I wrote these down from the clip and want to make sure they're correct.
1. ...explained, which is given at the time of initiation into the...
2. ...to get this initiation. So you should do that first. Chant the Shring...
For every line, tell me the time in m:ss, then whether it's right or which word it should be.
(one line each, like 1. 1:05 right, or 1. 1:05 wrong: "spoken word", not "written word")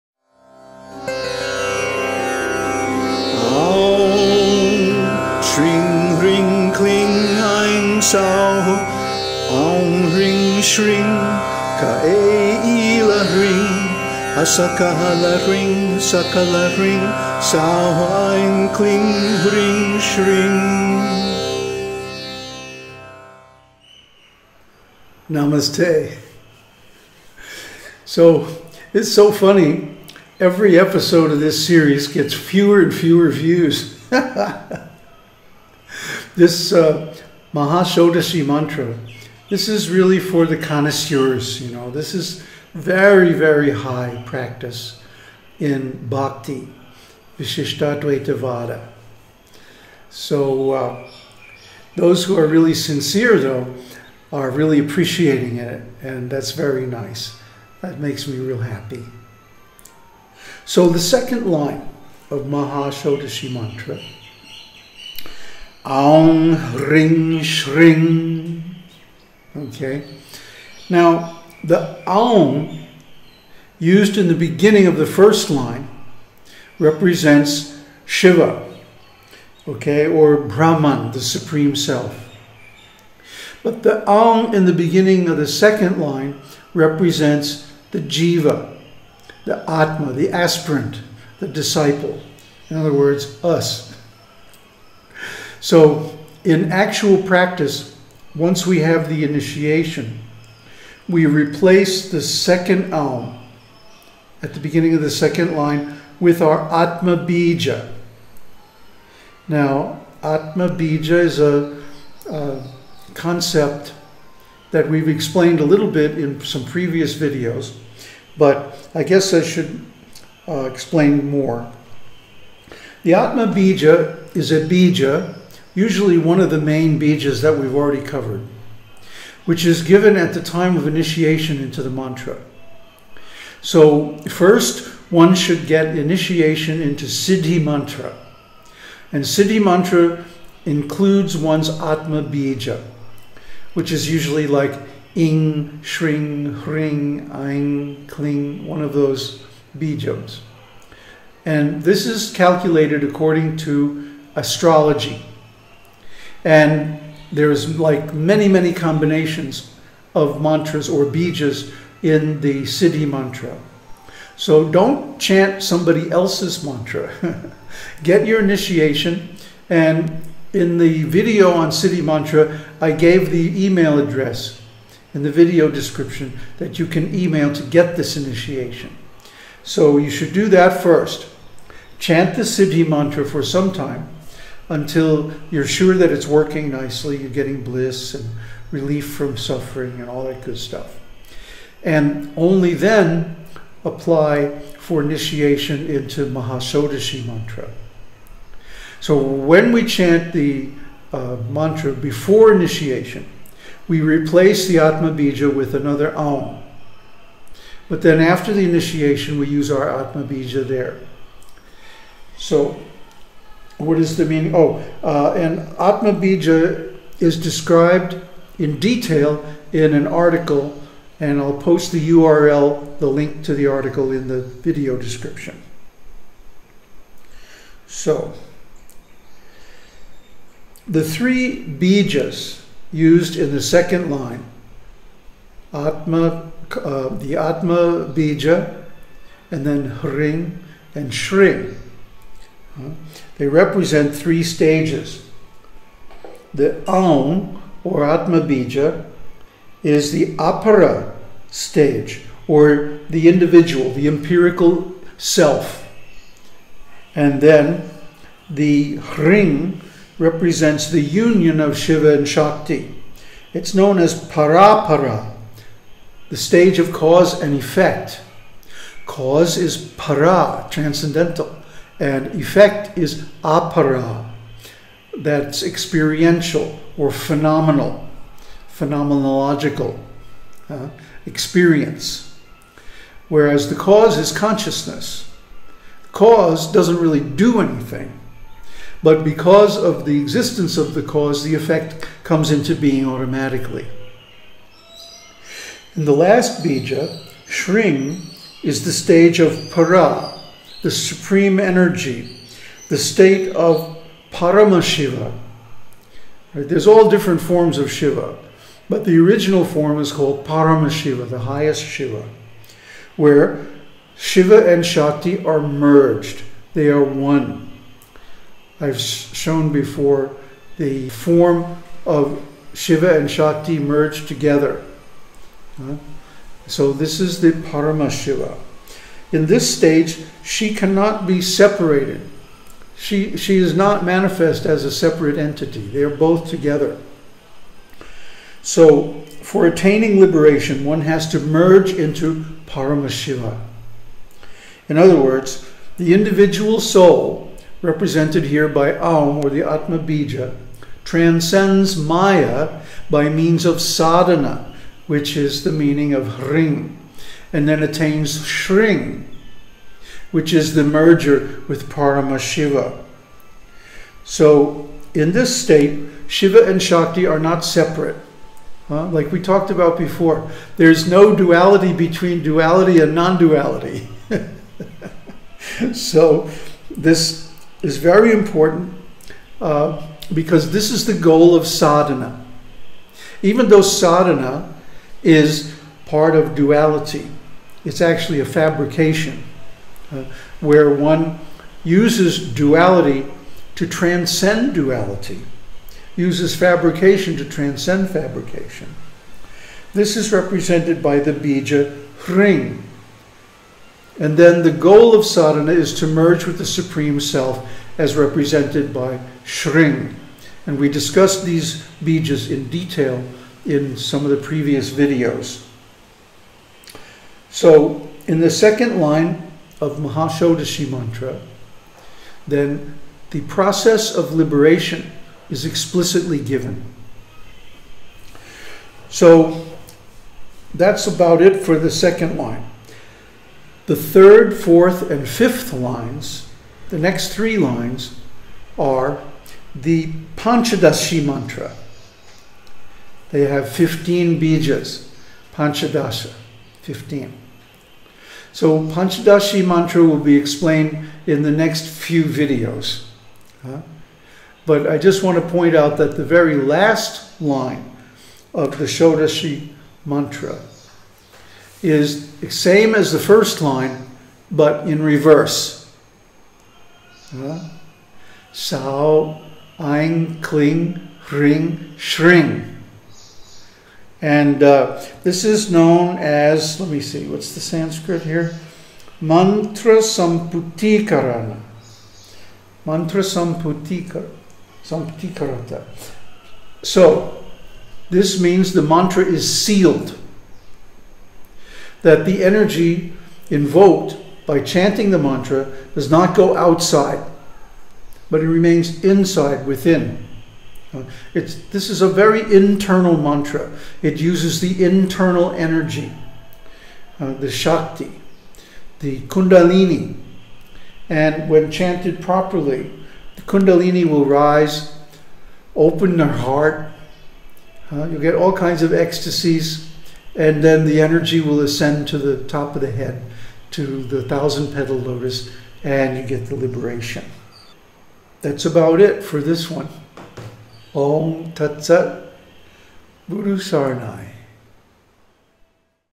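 1. 2:08 wrong: "covered", not "explained"
2. 2:57 wrong: "Siddhi", not "Shring".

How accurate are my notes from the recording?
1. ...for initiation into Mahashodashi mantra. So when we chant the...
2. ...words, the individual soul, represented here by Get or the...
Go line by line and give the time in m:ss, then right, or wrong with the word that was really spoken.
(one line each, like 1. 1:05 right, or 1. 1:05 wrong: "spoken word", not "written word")
1. 3:14 right
2. 5:45 wrong: "Aum", not "Get".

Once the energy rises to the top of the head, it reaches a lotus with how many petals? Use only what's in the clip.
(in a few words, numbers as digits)
1000.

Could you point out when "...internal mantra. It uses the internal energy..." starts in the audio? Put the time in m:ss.
8:22.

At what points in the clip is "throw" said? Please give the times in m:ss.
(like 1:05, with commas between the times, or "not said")
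not said.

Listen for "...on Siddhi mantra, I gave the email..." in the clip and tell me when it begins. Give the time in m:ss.
2:51.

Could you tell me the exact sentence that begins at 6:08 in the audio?
Uh, like we talked about before, there's no duality between duality and non duality.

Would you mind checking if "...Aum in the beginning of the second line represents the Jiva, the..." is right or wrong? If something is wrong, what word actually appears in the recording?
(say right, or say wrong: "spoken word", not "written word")
right.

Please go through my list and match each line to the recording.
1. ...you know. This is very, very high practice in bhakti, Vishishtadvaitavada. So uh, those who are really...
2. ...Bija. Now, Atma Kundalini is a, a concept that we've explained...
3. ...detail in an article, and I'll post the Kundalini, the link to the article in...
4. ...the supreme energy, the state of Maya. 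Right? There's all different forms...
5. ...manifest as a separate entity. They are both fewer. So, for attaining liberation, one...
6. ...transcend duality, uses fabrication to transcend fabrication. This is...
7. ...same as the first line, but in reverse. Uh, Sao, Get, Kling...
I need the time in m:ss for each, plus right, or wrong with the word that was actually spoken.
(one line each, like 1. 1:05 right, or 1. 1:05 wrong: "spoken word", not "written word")
1. 0:41 right
2. 1:47 wrong: "Bija", not "Kundalini"
3. 3:38 wrong: "URL", not "Kundalini"
4. 5:00 wrong: "Paramashiva", not "Maya"
5. 5:34 wrong: "together", not "fewer"
6. 6:33 right
7. 7:42 wrong: "Ein", not "Get".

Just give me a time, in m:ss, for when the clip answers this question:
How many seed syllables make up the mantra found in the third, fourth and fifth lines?
7:23.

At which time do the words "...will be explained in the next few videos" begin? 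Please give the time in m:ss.
7:30.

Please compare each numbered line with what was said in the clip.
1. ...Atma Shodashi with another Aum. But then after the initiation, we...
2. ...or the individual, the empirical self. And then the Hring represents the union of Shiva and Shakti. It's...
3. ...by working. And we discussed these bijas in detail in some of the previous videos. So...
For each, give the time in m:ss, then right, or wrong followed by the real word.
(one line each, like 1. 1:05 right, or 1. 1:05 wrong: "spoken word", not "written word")
1. 3:24 wrong: "Bija", not "Shodashi"
2. 4:12 right
3. 6:48 wrong: "shring", not "working".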